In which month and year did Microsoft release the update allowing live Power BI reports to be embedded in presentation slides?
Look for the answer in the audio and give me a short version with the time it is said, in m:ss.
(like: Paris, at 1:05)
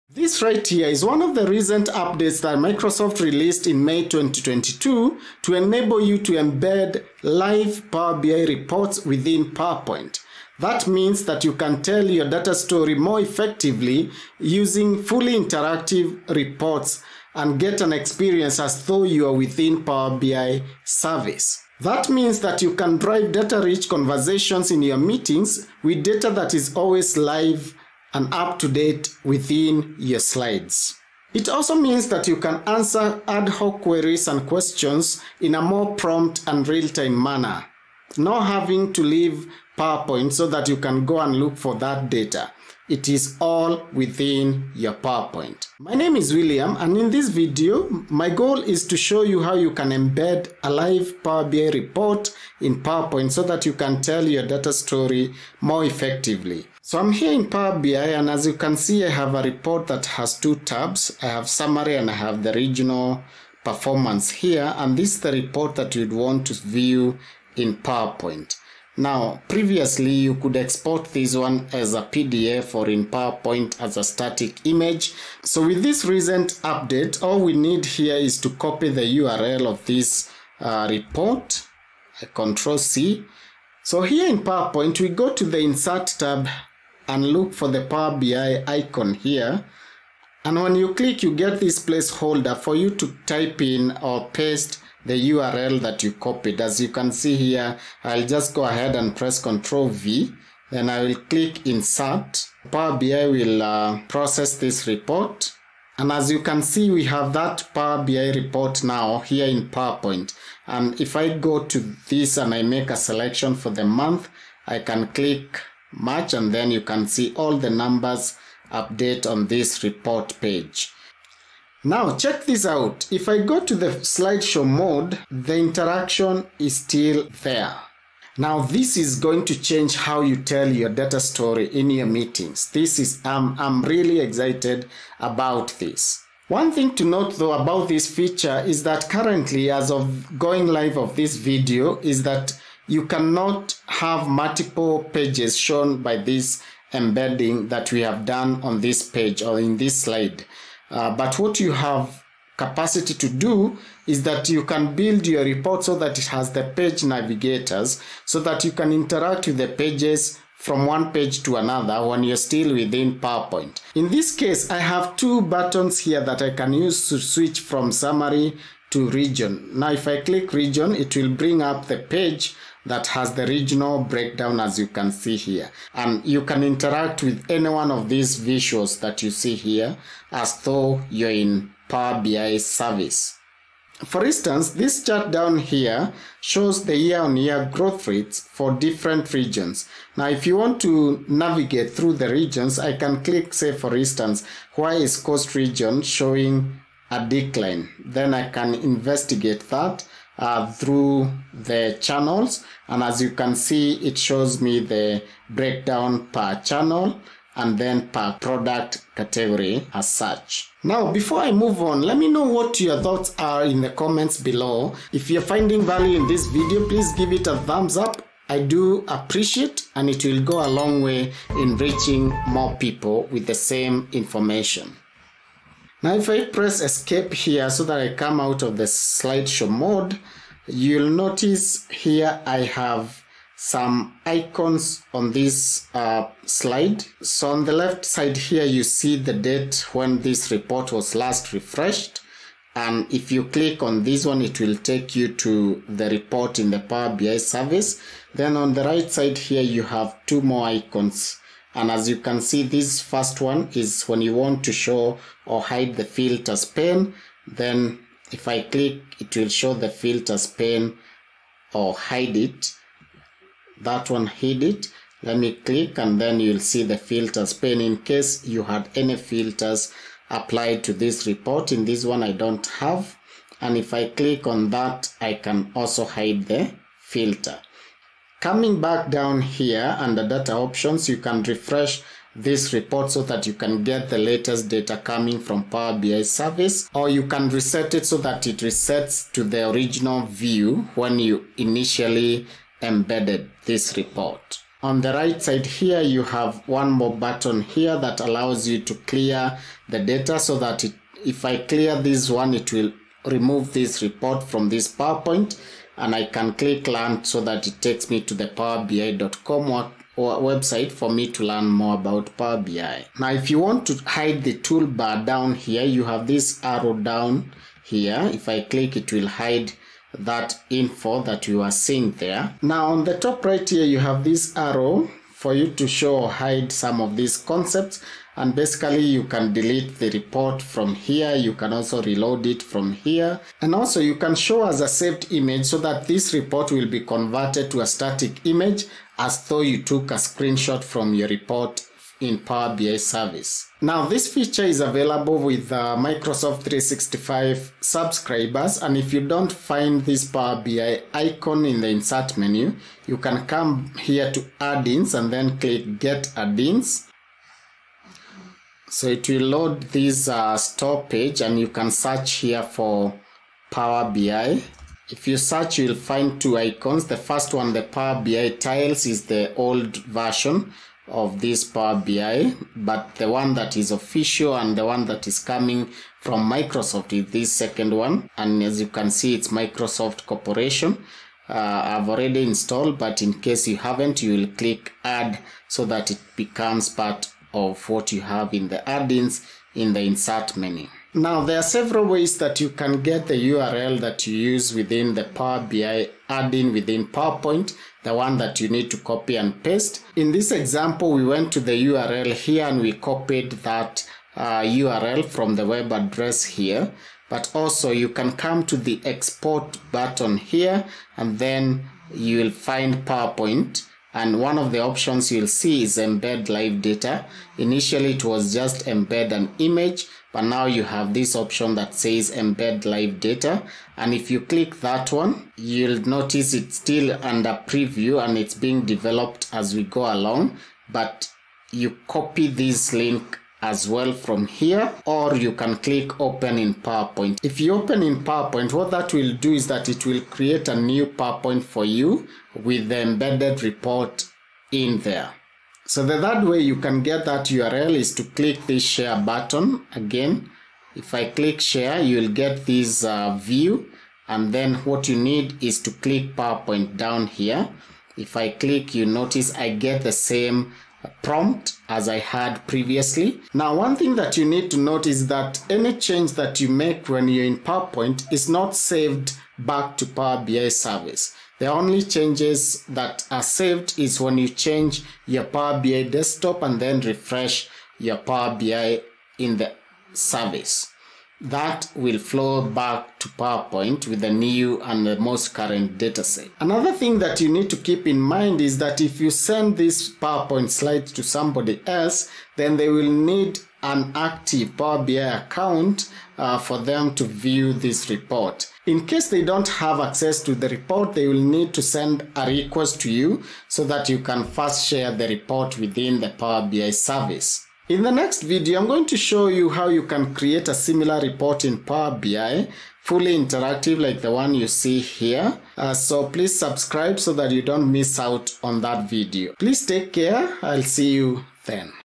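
May 2022, at 0:03.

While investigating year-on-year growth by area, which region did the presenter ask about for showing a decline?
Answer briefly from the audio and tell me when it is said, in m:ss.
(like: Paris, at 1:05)
Coast, at 3:15.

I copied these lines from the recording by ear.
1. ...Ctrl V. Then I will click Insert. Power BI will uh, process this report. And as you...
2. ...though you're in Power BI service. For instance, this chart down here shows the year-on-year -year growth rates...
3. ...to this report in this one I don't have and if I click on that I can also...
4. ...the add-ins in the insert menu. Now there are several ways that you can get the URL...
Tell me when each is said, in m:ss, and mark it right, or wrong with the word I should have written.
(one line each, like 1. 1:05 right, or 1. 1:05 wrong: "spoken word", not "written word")
1. 1:39 right
2. 3:00 right
3. 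4:30 right
4. 6:28 right.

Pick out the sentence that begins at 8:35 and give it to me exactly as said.
Uh, so please subscribe so that you don't miss out on that video.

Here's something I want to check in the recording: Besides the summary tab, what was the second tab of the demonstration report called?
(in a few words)
Regional performance.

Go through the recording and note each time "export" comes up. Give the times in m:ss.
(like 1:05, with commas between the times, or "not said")
1:10, 6:49.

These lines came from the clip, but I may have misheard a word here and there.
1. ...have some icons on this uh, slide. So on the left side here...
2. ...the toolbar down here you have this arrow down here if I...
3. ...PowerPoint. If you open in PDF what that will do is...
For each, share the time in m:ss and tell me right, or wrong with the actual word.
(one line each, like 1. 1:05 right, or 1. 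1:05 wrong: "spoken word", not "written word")
1. 3:52 right
2. 5:14 right
3. 7:16 wrong: "PowerPoint", not "PDF".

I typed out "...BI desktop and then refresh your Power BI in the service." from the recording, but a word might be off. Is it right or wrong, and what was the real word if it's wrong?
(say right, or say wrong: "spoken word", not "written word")
right.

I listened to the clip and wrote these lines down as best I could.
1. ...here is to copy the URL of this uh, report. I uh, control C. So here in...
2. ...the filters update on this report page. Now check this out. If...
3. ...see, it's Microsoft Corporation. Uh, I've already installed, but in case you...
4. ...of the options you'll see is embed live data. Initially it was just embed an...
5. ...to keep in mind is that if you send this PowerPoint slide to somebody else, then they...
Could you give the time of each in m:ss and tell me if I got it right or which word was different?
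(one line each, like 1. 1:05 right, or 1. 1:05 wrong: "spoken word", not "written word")
1. 1:17 right
2. 1:57 wrong: "numbers", not "filters"
3. 6:19 right
4. 6:54 right
5. 8:07 right.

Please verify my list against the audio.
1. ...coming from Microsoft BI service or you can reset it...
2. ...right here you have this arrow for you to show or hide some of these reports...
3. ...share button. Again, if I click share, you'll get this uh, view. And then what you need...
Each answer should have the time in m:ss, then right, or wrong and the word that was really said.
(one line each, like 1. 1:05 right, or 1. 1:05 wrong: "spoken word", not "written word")
1. 4:44 wrong: "Power", not "Microsoft"
2. 5:23 wrong: "concepts", not "reports"
3. 7:28 right.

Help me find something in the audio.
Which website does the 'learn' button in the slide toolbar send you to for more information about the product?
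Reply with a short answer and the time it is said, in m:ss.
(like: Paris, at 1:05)
powerbi.com, at 5:08.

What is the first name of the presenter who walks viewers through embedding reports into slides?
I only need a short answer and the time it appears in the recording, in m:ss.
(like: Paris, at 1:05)
William, at 0:46.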